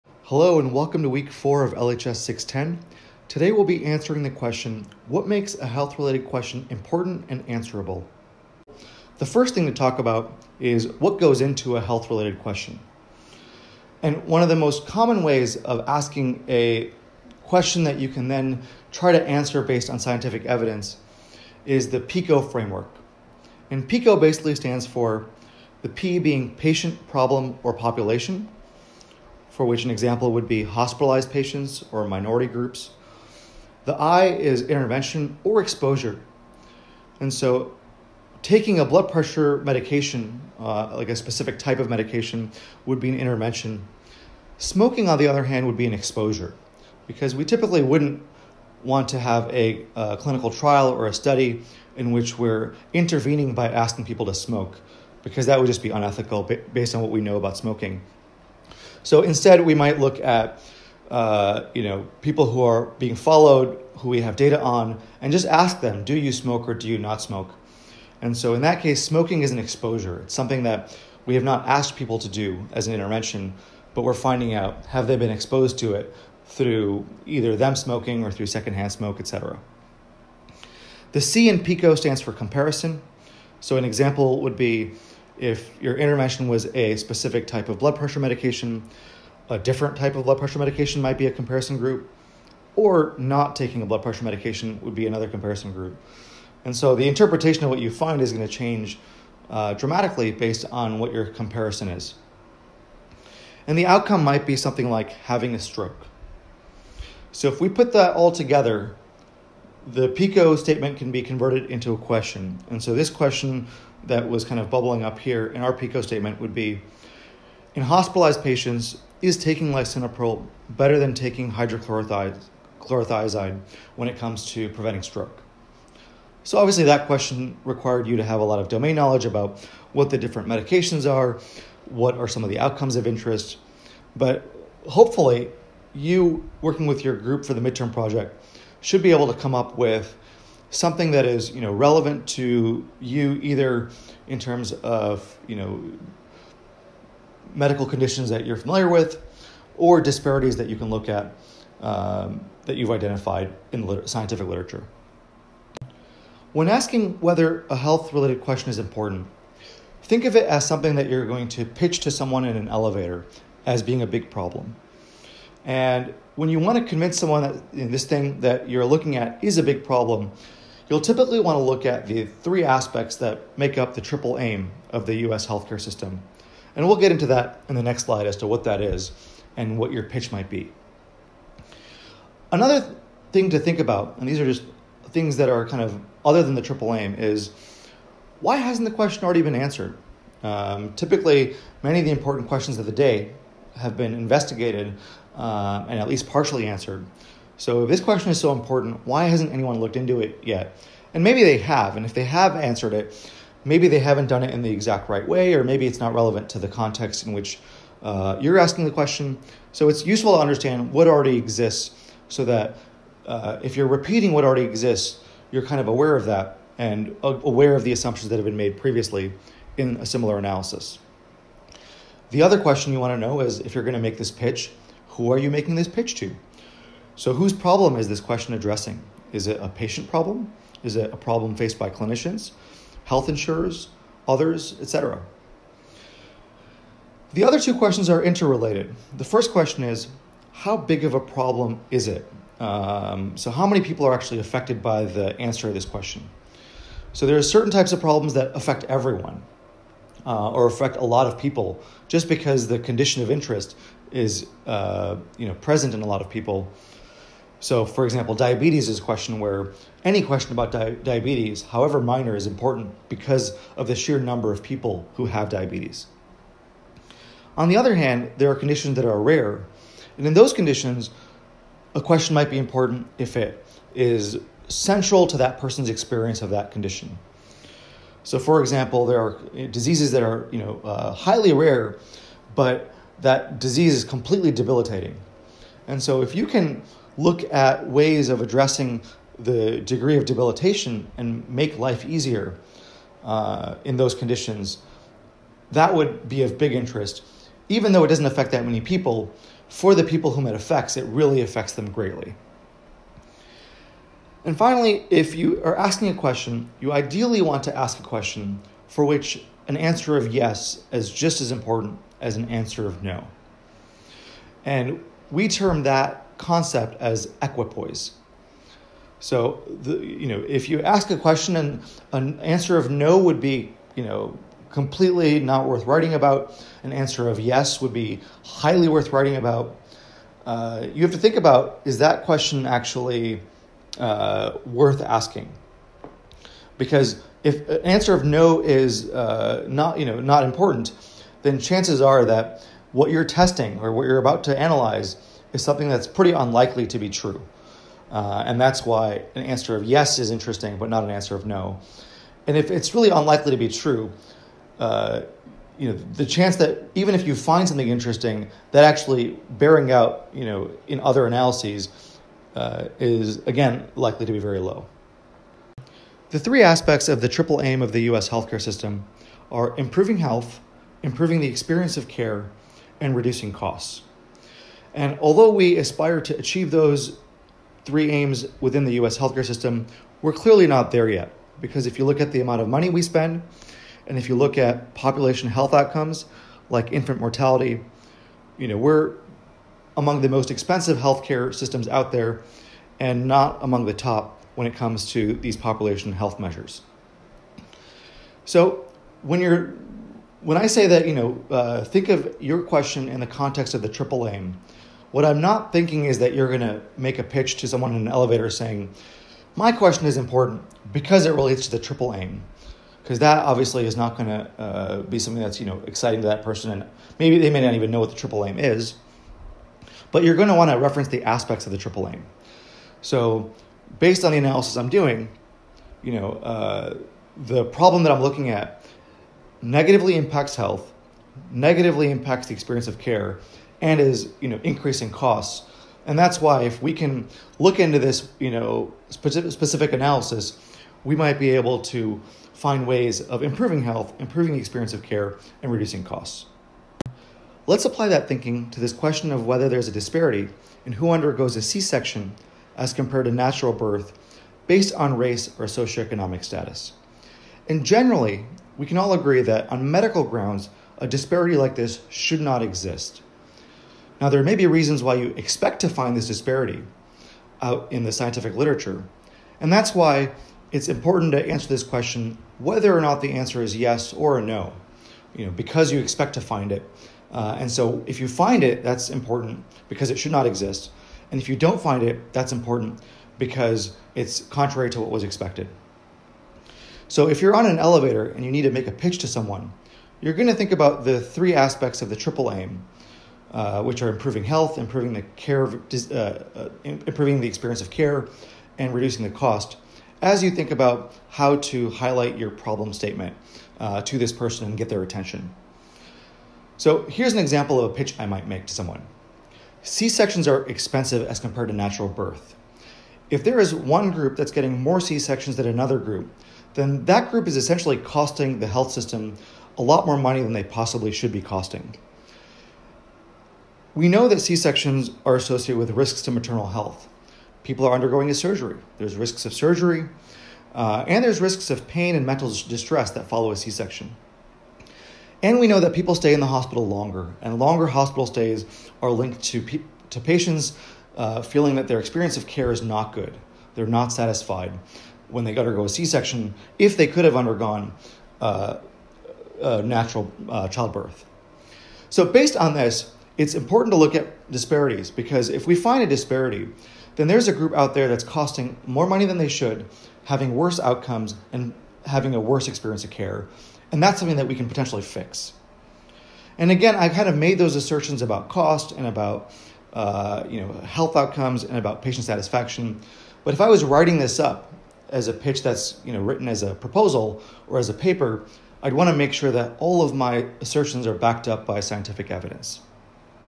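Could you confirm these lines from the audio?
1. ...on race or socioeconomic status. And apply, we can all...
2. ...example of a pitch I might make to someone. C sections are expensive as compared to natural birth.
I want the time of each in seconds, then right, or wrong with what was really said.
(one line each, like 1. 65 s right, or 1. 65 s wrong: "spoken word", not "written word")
1. 454 s wrong: "generally", not "apply"
2. 507 s right.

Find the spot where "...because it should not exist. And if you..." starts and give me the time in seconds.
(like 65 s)
479 s.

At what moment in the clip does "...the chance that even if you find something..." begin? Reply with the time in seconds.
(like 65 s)
356 s.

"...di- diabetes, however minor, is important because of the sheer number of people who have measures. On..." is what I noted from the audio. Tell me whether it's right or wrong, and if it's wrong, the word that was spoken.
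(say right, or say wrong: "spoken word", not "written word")
wrong: "diabetes", not "measures".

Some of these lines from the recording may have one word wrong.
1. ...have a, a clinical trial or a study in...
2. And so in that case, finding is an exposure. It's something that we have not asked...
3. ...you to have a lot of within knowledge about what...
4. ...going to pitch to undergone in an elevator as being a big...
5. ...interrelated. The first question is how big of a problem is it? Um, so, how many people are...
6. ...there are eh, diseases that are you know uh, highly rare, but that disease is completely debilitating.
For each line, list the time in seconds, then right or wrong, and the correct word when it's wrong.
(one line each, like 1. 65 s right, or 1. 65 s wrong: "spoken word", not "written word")
1. 49 s right
2. 68 s wrong: "smoking", not "finding"
3. 128 s wrong: "domain", not "within"
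4. 161 s wrong: "someone", not "undergone"
5. 238 s right
6. 279 s right.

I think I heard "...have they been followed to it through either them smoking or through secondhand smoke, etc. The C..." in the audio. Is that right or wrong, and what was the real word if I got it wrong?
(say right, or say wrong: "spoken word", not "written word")
wrong: "exposed", not "followed".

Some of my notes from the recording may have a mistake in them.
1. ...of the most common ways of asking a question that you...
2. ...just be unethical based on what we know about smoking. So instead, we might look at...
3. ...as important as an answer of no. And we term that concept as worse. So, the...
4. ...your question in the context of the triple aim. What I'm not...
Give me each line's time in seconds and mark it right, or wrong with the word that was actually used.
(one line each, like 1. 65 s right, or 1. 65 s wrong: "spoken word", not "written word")
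1. 14 s right
2. 55 s right
3. 311 s wrong: "equipoise", not "worse"
4. 402 s right.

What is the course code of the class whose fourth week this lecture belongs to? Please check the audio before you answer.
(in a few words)
LHS 610.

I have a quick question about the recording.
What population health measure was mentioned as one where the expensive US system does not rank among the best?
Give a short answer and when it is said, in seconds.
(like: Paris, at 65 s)
infant mortality, at 386 s.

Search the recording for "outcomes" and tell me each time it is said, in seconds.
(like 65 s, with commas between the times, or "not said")
103 s, 132 s, 385 s, 560 s, 571 s.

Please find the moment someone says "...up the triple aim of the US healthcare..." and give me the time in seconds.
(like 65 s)
173 s.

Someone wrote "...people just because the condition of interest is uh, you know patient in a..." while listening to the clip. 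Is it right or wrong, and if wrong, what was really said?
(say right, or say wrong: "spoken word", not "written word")
wrong: "present", not "patient".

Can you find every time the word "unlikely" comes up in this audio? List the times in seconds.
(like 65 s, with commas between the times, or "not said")
346 s, 353 s.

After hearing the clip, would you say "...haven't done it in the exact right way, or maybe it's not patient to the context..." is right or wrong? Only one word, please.
wrong.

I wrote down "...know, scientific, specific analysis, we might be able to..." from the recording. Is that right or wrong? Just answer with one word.
wrong.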